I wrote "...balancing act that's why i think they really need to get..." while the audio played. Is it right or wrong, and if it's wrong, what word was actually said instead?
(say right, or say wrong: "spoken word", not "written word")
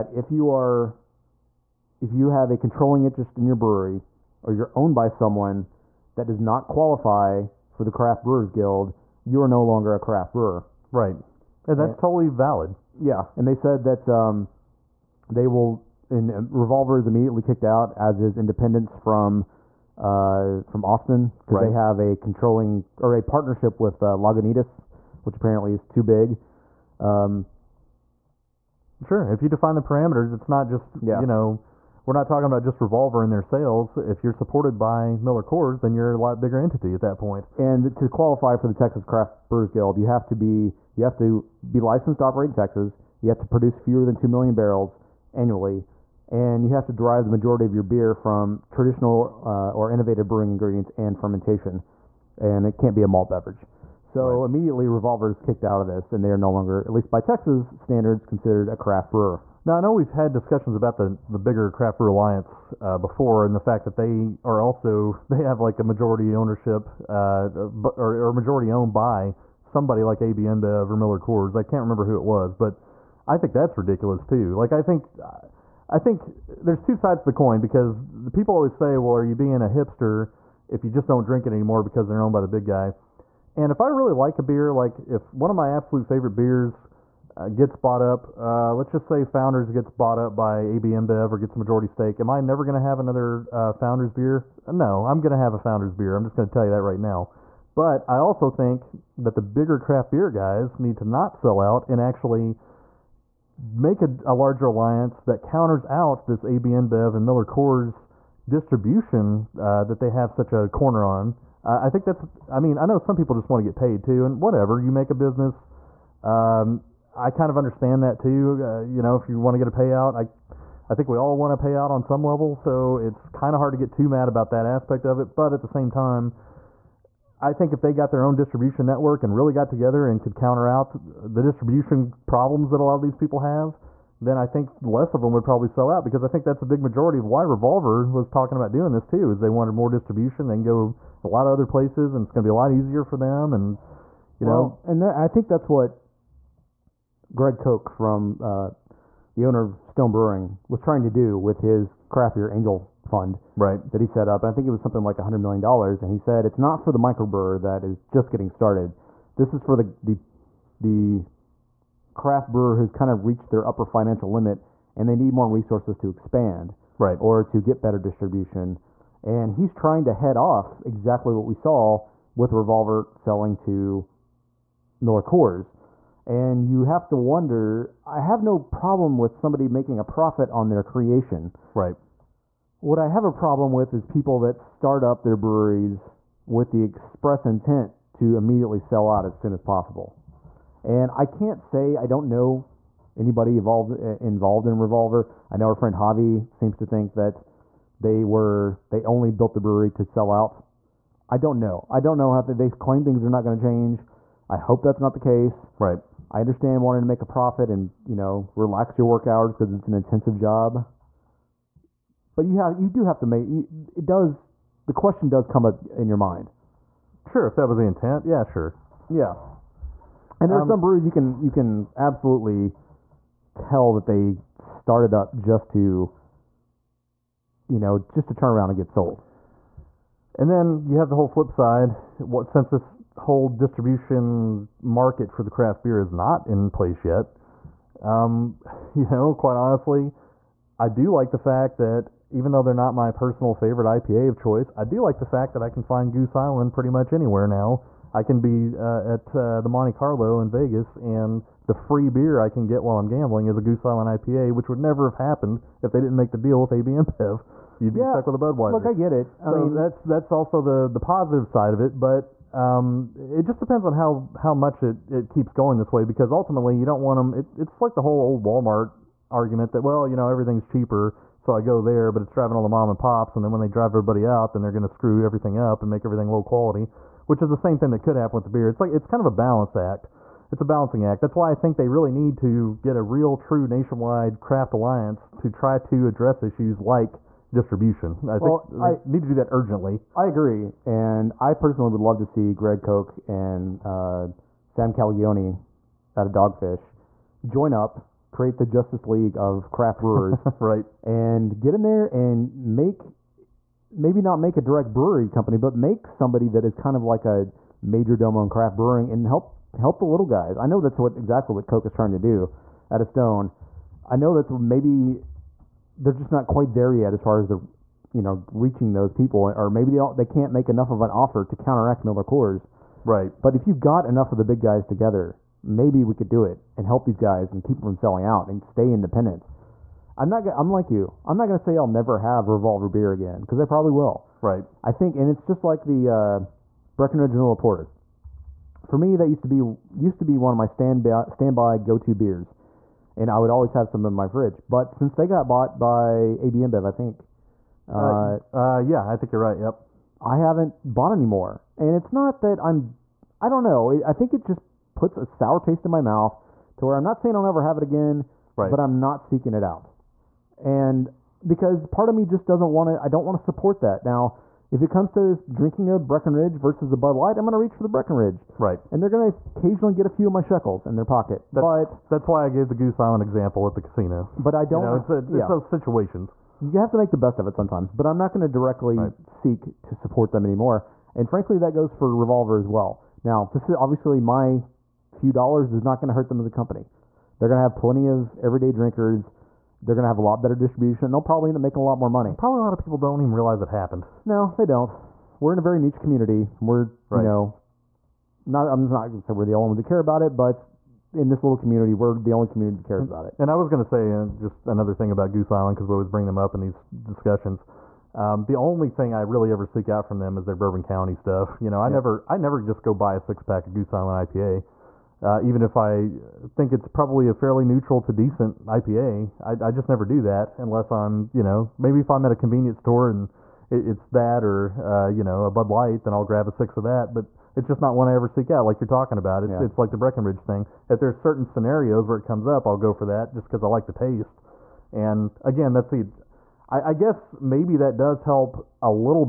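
right.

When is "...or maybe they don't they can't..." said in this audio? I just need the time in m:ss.
5:19.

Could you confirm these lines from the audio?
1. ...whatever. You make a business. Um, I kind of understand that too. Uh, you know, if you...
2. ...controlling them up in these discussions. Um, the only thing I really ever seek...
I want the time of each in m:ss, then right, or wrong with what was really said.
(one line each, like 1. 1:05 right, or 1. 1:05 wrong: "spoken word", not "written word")
1. 1:54 right
2. 6:46 wrong: "bring", not "controlling".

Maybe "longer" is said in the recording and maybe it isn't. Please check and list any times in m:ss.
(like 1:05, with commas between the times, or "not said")
0:09, 0:56.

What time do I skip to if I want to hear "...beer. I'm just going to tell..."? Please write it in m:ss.
1:35.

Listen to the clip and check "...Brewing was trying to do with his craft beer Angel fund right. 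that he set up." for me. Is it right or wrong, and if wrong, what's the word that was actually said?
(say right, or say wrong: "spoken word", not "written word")
right.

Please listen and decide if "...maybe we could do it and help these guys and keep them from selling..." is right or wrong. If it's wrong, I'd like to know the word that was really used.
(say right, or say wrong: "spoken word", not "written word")
right.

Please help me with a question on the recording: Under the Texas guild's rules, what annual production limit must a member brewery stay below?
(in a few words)
fewer than 2 million barrels.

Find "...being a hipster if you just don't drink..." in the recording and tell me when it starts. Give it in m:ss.
1:19.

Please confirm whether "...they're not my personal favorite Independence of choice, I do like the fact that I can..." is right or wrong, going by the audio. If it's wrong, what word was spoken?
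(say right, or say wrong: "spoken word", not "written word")
wrong: "IPA", not "Independence".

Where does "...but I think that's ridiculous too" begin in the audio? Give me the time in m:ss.
1:12.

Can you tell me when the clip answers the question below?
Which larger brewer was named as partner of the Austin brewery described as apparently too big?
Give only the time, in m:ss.
0:24.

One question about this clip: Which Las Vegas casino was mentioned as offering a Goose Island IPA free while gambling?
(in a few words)
Monte Carlo.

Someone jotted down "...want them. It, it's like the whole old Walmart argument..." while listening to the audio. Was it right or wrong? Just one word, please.
right.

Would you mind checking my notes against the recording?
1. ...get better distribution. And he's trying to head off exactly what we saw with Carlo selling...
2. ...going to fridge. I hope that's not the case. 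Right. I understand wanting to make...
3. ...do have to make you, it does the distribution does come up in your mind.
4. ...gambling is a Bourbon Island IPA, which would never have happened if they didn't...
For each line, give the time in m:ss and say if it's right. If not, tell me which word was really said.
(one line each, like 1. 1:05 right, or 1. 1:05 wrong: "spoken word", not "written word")
1. 2:47 wrong: "Revolver", not "Carlo"
2. 3:23 wrong: "change", not "fridge"
3. 3:32 wrong: "question", not "distribution"
4. 4:13 wrong: "Goose", not "Bourbon".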